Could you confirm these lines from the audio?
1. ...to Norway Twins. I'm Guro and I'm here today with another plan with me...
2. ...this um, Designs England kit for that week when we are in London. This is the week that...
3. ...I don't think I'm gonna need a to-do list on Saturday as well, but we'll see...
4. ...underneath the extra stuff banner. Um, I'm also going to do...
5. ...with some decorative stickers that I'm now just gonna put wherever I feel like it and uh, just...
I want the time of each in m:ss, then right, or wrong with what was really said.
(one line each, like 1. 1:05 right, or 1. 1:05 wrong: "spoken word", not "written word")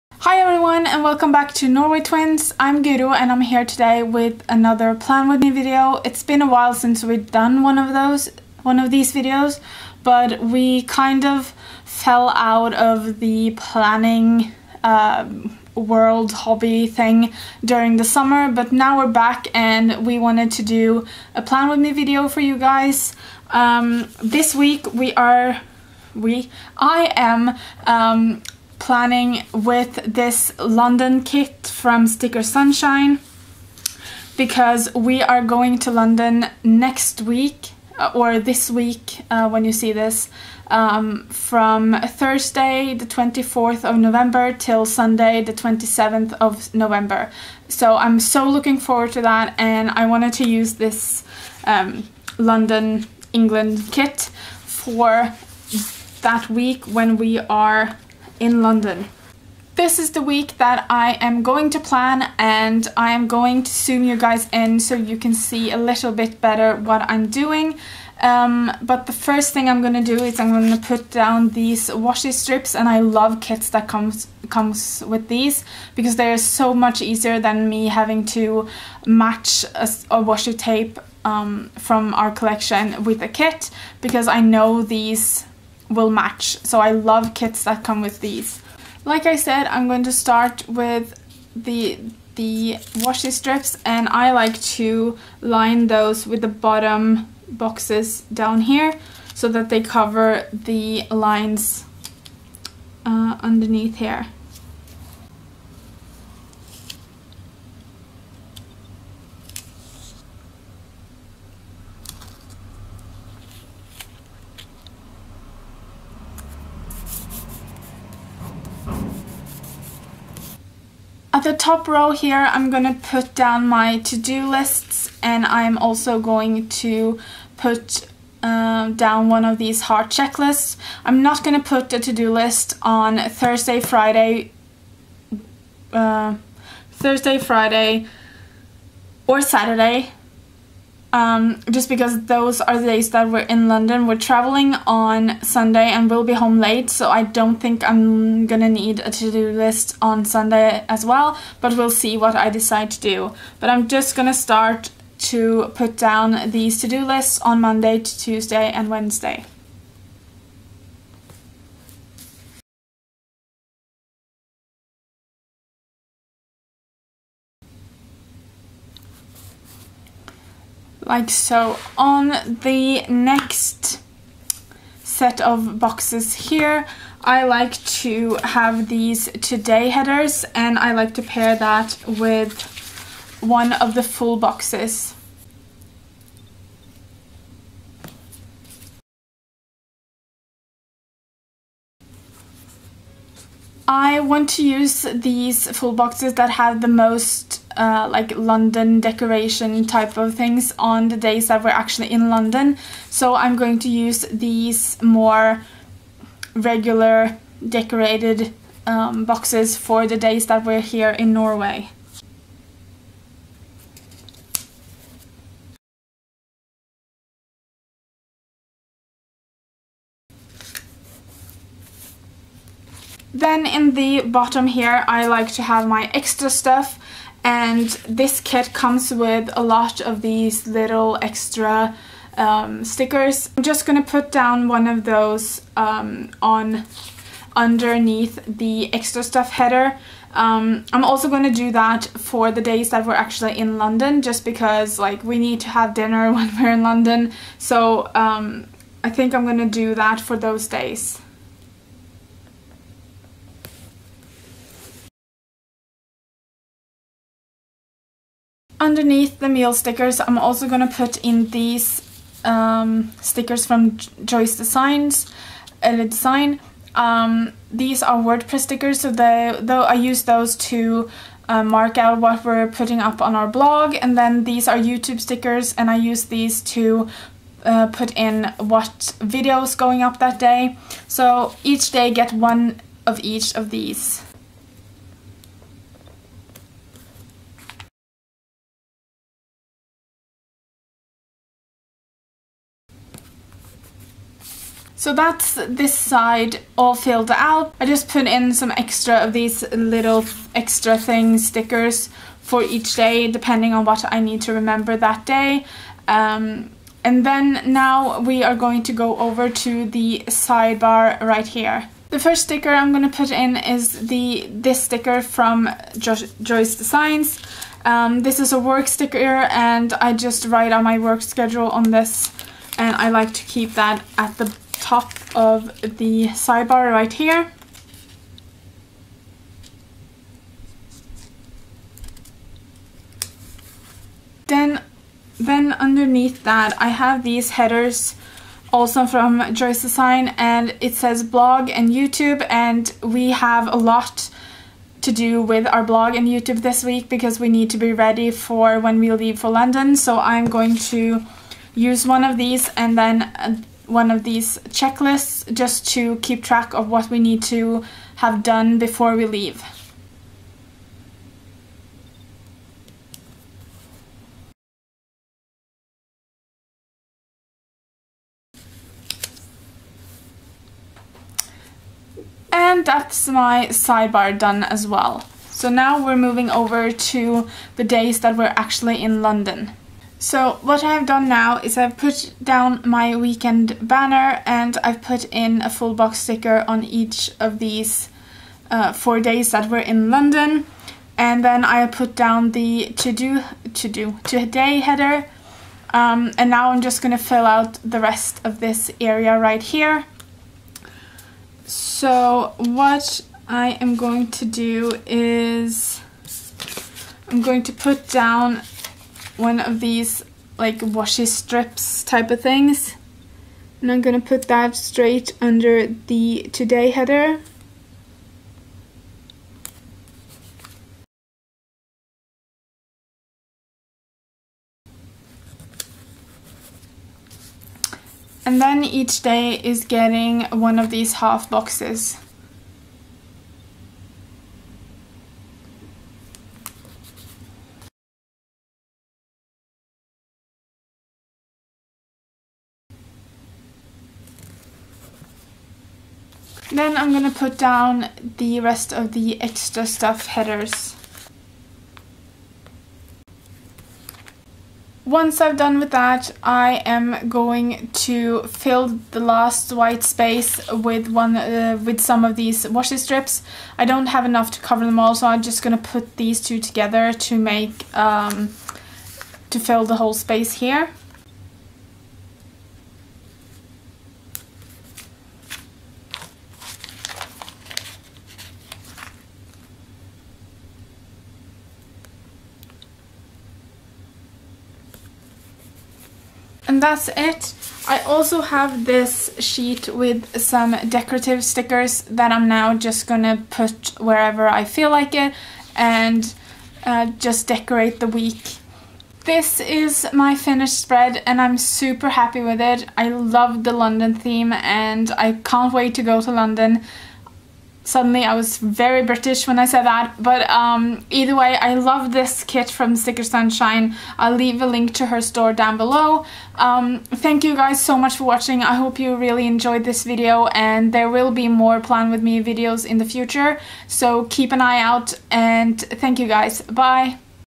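1. 0:01 right
2. 0:50 wrong: "London", not "Designs"
3. 2:27 wrong: "Sunday", not "Saturday"
4. 3:57 wrong: "header", not "banner"
5. 8:09 right.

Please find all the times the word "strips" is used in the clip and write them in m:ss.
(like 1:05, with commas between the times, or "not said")
1:12, 1:33, 6:51, 7:42.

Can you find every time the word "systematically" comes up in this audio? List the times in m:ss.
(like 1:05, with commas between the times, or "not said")
not said.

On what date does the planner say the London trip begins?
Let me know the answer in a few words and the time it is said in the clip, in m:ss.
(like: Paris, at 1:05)
Thursday 24 November, at 0:42.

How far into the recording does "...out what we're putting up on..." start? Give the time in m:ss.
4:31.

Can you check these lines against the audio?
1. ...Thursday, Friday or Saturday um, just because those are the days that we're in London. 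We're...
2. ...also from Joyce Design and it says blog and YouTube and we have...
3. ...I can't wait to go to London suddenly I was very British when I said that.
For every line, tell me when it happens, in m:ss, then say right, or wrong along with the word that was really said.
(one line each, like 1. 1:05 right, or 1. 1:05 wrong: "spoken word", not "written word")
1. 2:16 right
2. 5:38 right
3. 8:25 right.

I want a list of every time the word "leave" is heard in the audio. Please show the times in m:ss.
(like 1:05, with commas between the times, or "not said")
5:49, 5:59, 8:34.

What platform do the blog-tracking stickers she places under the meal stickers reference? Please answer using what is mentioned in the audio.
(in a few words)
WordPress.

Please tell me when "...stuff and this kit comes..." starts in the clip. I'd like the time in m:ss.
3:46.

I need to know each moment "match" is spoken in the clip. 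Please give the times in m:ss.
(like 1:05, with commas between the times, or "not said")
1:19, 1:26.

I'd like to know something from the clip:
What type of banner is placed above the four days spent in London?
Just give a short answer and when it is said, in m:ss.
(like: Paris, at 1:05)
Weekend banner, at 6:23.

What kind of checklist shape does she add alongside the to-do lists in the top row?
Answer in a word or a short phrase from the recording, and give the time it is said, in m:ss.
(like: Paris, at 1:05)
Heart, at 2:09.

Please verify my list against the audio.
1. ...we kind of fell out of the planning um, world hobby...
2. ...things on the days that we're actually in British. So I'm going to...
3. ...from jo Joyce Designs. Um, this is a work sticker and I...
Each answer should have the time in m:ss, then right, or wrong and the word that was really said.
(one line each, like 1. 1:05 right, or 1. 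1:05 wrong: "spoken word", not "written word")
1. 0:10 right
2. 3:20 wrong: "London", not "British"
3. 5:15 right.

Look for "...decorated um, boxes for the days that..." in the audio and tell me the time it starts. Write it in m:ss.
3:27.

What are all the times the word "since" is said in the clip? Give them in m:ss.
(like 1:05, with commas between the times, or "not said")
0:06.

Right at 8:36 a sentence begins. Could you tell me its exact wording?
Um, thank you guys so much for watching.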